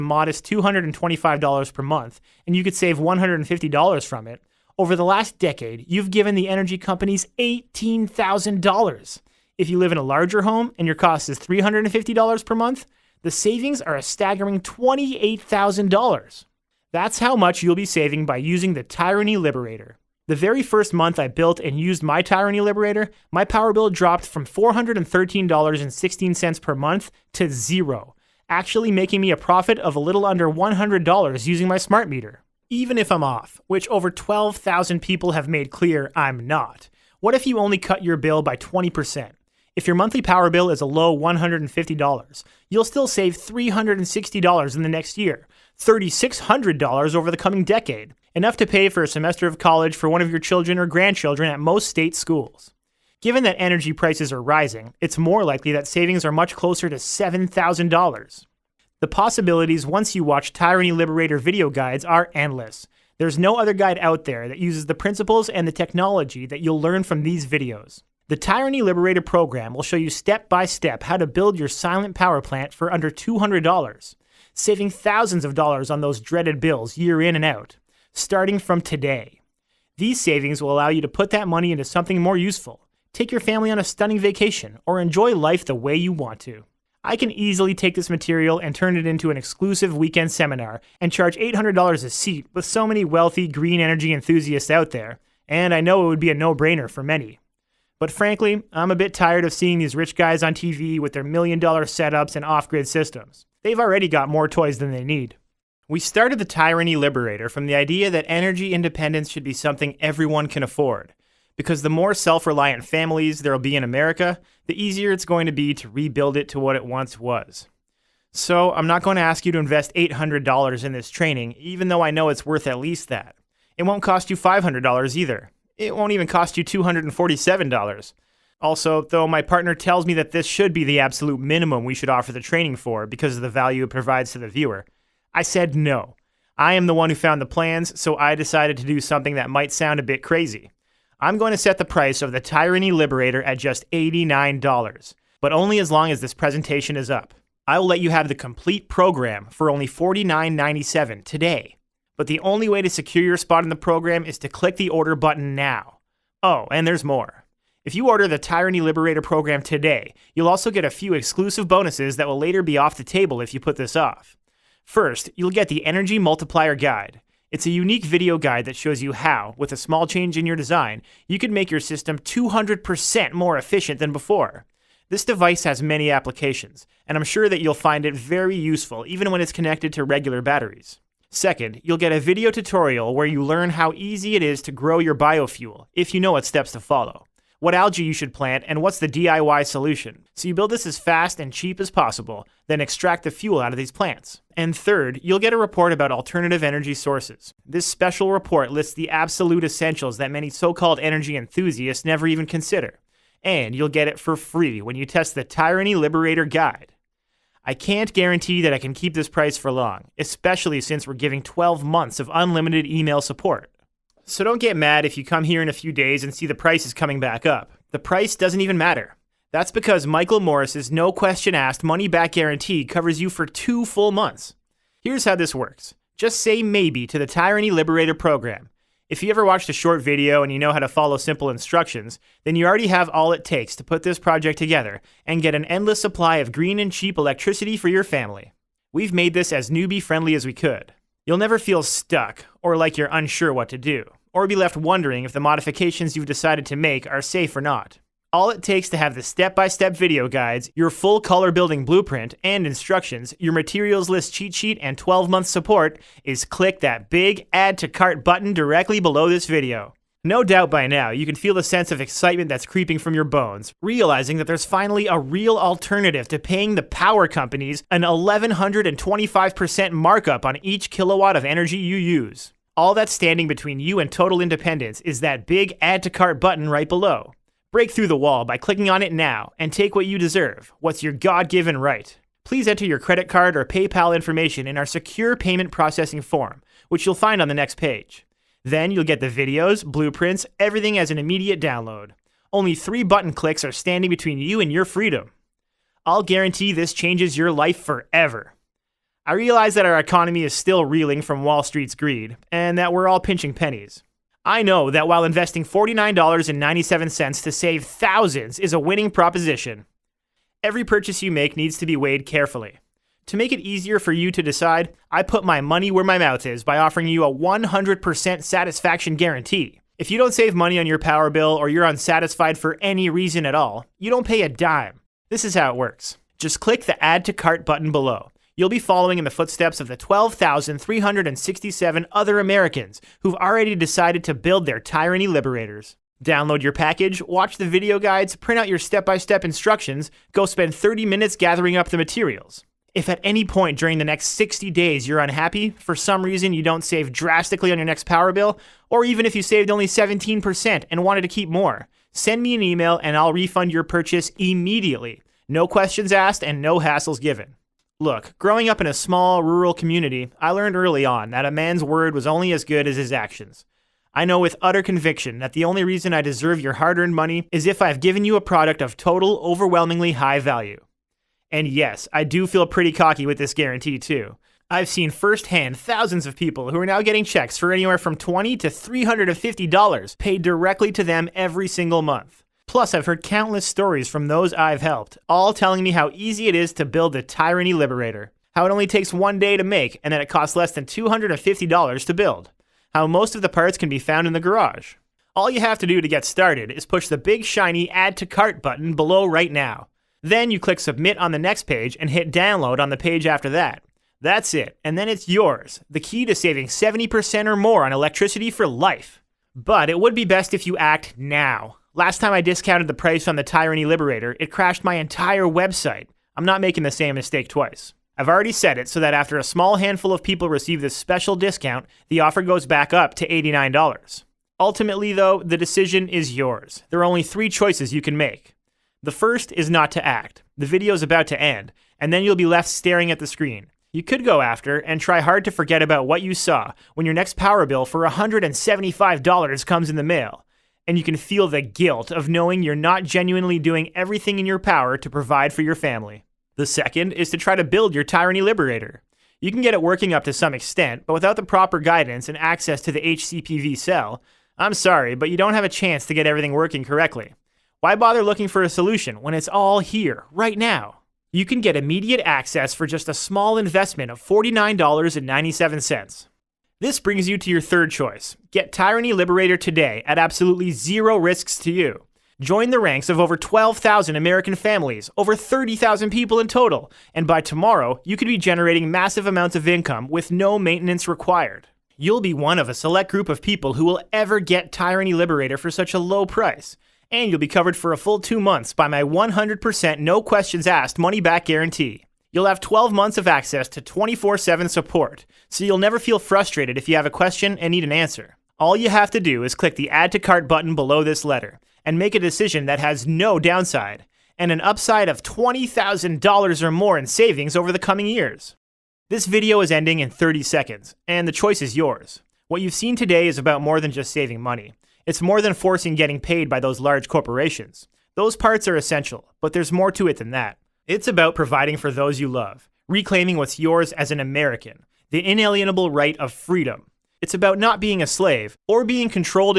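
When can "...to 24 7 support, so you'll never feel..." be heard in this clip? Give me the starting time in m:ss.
8:13.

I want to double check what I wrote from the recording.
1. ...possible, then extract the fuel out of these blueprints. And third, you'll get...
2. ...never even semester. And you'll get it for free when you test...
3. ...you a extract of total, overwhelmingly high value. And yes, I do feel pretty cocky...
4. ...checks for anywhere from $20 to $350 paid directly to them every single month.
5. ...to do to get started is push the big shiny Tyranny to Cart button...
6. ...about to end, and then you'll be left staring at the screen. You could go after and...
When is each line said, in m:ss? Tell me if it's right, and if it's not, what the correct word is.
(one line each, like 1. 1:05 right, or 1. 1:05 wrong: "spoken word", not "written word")
1. 3:11 wrong: "plants", not "blueprints"
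2. 3:22 wrong: "consider", not "semester"
3. 6:08 wrong: "product", not "extract"
4. 6:17 right
5. 6:35 wrong: "Add", not "Tyranny"
6. 7:11 right.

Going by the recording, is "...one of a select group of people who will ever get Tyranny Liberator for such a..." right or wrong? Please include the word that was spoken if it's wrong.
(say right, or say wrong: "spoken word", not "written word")
right.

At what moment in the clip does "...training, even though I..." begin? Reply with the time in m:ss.
2:01.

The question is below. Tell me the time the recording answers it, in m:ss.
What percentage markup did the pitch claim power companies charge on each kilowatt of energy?
4:28.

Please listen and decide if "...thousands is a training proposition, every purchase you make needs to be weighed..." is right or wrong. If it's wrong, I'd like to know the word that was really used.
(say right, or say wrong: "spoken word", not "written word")
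wrong: "winning", not "training".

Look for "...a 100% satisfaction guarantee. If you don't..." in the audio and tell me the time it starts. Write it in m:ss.
5:17.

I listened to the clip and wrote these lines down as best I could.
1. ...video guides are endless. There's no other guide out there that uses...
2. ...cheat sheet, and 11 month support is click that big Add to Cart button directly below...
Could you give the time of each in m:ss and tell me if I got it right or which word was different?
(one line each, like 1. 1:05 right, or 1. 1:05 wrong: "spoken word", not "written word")
1. 1:01 right
2. 4:14 wrong: "12", not "11".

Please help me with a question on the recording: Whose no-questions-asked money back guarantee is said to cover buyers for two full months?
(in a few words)
Michael Morris.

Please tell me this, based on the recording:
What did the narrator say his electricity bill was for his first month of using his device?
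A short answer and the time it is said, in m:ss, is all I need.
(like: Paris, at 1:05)
$413.16, at 0:24.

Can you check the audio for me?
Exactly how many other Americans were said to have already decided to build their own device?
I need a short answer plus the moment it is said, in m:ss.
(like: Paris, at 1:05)
12,367, at 5:29.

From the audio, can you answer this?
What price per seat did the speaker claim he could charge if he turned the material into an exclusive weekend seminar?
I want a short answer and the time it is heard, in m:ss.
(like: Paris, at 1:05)
$800, at 1:31.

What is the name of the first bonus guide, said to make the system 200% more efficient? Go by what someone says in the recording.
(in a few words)
Energy Multiplier Guide.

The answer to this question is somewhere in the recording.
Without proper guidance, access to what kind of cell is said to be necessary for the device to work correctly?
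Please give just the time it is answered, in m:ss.
7:33.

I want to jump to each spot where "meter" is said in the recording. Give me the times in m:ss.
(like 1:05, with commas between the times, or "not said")
0:32.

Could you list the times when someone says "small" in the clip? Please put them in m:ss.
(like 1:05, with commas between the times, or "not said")
2:49, 5:58, 6:59, 7:43.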